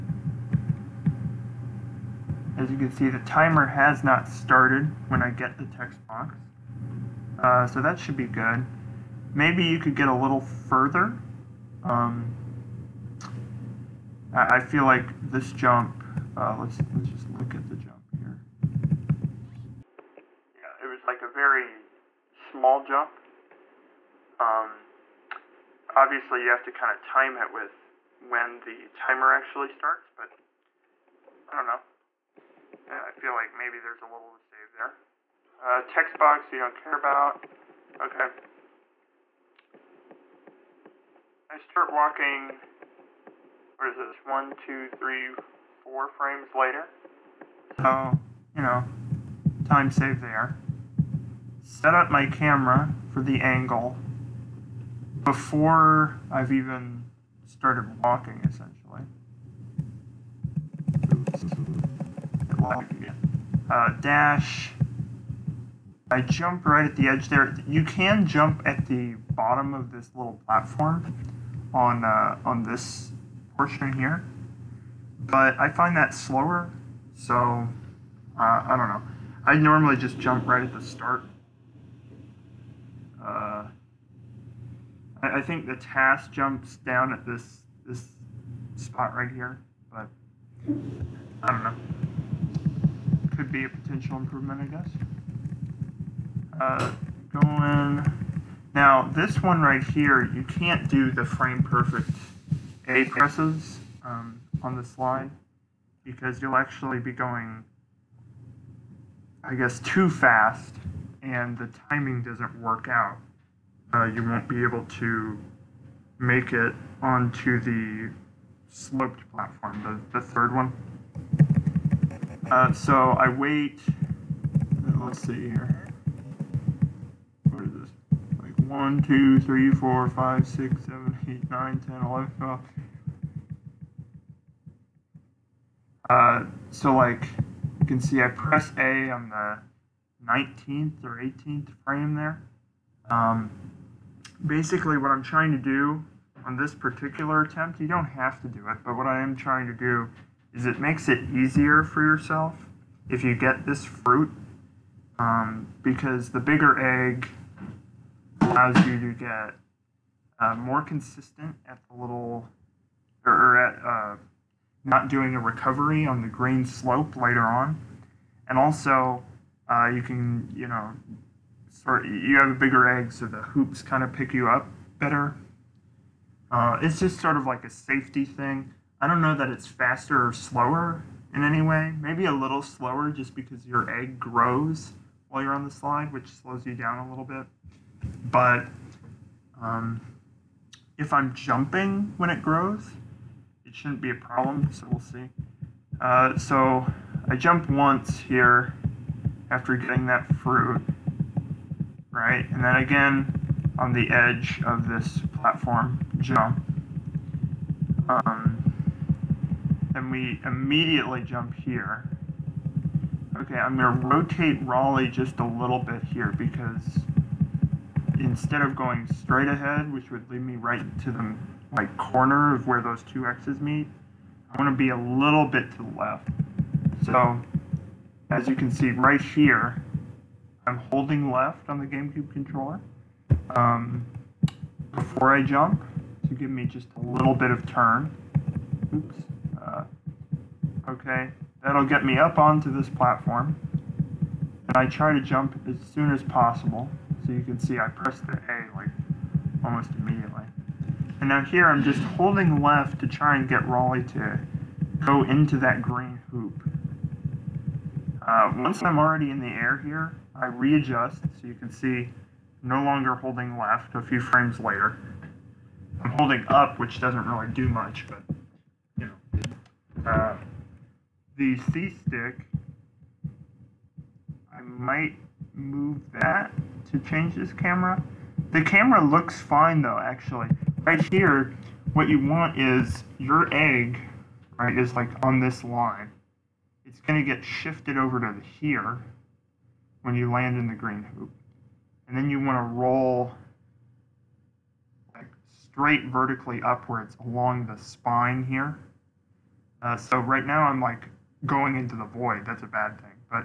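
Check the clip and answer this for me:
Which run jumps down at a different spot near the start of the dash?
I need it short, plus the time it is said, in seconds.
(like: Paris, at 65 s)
The TAS, at 85 s.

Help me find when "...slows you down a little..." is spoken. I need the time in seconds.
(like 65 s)
186 s.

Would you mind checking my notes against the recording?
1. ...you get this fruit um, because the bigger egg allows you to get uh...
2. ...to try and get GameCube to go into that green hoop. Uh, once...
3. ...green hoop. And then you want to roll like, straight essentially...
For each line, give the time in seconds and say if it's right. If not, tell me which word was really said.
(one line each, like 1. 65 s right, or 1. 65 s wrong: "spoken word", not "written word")
1. 153 s right
2. 252 s wrong: "Rolly", not "GameCube"
3. 290 s wrong: "vertically", not "essentially".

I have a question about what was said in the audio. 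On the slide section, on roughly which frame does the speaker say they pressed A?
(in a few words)
19th or 18th.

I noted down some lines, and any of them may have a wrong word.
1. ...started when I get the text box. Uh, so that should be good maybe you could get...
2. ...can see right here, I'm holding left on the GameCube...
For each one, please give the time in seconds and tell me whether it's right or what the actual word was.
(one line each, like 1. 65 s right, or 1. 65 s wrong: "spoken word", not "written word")
1. 4 s right
2. 228 s right.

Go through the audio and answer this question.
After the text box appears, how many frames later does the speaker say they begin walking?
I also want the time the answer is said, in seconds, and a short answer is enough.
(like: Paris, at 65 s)
4, at 45 s.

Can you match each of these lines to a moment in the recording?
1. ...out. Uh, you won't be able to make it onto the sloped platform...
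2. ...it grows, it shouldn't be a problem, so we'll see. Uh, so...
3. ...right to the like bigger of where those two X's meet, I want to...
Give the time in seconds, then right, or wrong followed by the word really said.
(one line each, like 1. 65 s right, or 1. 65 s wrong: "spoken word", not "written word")
1. 112 s right
2. 192 s right
3. 220 s wrong: "corner", not "bigger".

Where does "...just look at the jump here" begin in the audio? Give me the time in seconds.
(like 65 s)
17 s.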